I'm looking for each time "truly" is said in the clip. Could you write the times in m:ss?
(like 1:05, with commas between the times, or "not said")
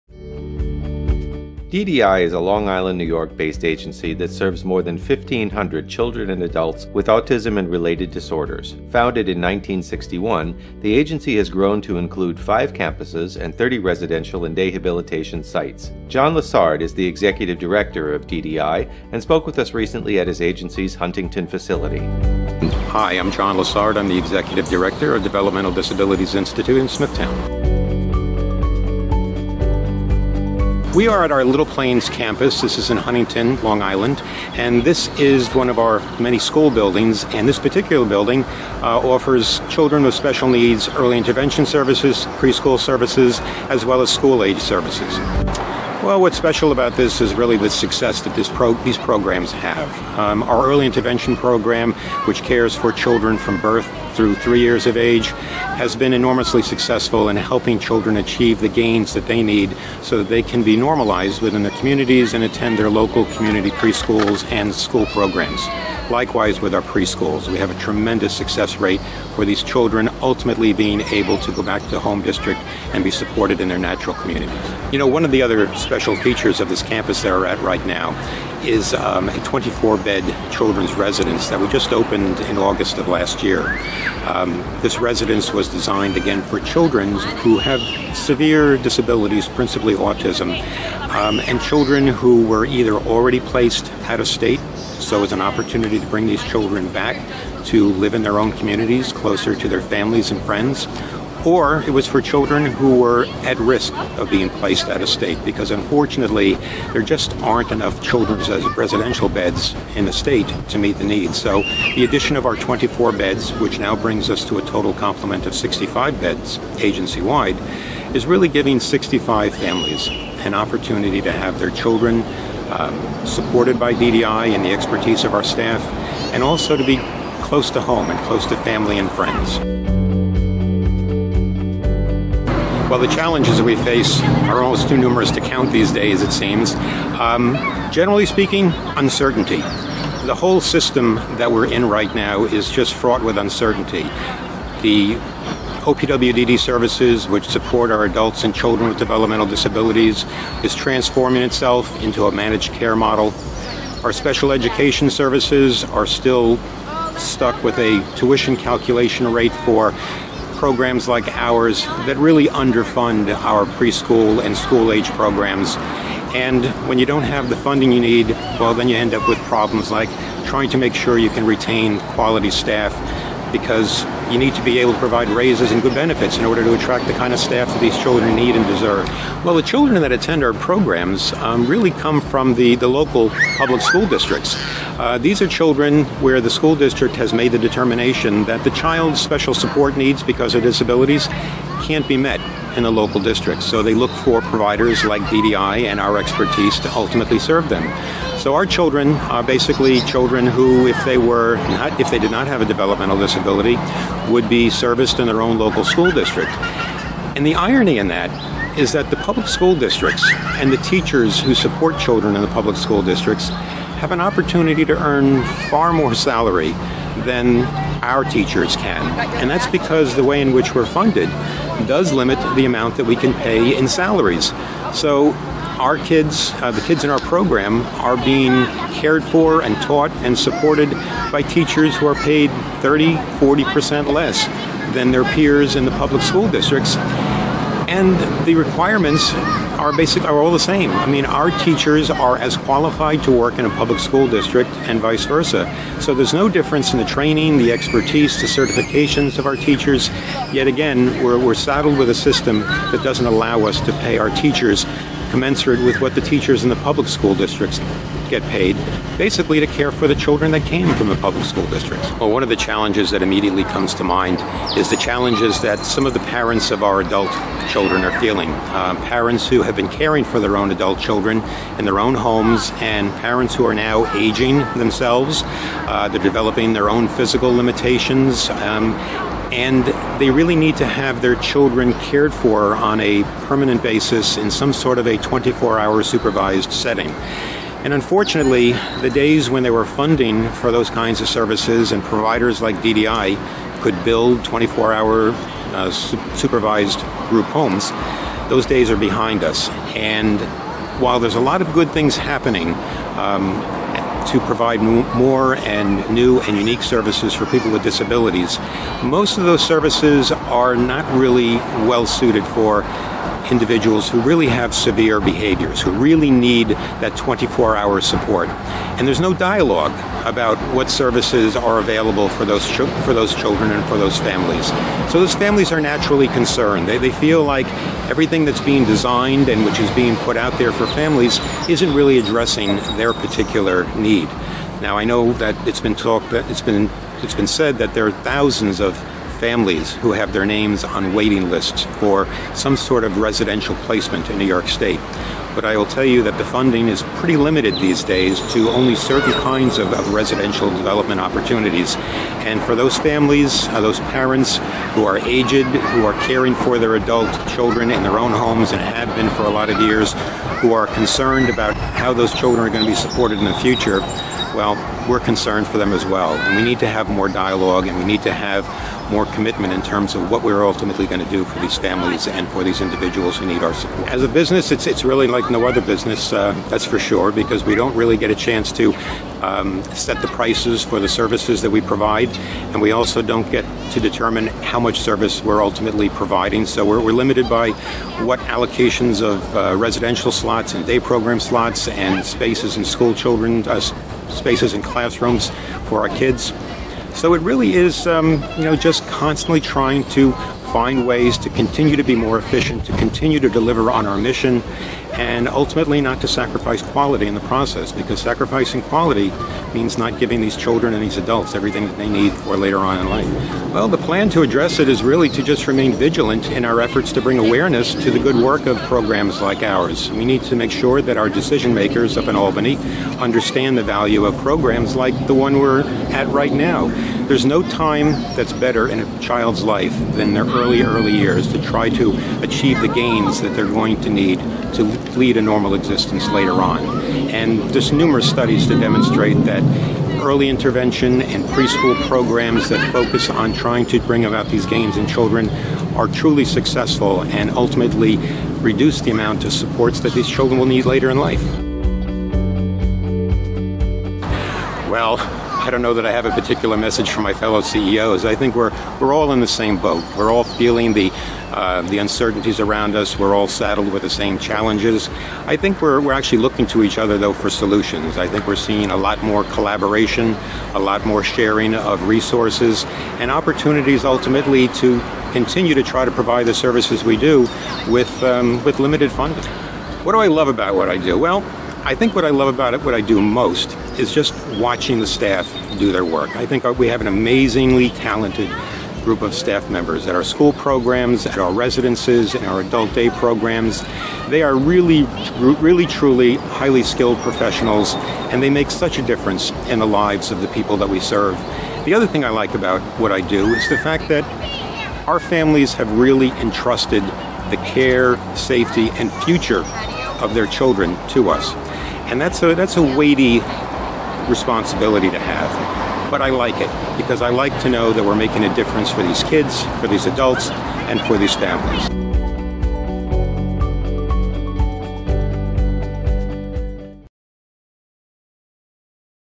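7:26, 8:15.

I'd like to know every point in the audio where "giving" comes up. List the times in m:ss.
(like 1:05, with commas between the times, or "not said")
1:58, 6:50.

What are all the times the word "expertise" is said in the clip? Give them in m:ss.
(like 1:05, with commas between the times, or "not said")
2:04, 3:16, 4:07.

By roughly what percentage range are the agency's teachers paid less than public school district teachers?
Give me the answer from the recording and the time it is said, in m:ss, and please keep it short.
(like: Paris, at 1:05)
30-40%, at 3:52.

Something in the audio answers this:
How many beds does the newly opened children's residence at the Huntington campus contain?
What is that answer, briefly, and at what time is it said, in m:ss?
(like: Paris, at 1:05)
24, at 1:19.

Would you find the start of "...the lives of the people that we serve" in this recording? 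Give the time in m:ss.
8:19.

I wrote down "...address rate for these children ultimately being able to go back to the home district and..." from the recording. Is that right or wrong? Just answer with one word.
wrong.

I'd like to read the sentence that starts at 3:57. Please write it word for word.
And the requirements are basically are all the same.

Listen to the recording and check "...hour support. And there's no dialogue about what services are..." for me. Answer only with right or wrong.
right.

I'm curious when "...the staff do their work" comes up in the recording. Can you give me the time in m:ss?
8:04.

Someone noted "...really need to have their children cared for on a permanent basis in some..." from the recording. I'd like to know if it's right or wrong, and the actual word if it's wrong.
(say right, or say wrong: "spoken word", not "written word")
right.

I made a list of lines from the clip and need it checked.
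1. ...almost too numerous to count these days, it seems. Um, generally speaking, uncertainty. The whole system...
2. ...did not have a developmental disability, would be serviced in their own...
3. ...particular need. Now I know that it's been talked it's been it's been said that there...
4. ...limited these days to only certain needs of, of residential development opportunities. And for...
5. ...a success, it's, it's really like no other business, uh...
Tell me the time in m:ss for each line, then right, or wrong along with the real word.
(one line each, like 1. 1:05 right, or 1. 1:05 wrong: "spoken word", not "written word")
1. 2:14 right
2. 3:22 right
3. 5:33 right
4. 5:47 wrong: "kinds", not "needs"
5. 6:14 wrong: "business", not "success".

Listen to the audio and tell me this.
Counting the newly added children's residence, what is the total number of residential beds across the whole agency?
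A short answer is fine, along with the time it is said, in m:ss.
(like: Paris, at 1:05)
65, at 1:55.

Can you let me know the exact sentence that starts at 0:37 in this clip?
And this particular building uh, offers children with special needs early intervention services, preschool services, as well as school age services.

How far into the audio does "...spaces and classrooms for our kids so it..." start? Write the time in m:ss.
6:34.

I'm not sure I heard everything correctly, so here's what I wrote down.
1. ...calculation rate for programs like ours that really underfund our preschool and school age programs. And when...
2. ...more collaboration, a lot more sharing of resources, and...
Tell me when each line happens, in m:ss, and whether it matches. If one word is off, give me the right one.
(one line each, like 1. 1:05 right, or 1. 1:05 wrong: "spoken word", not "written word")
1. 2:38 right
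2. 7:49 right.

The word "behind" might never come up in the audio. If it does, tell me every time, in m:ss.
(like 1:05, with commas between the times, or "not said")
4:58.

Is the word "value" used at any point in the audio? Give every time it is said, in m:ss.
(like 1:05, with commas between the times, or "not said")
7:03.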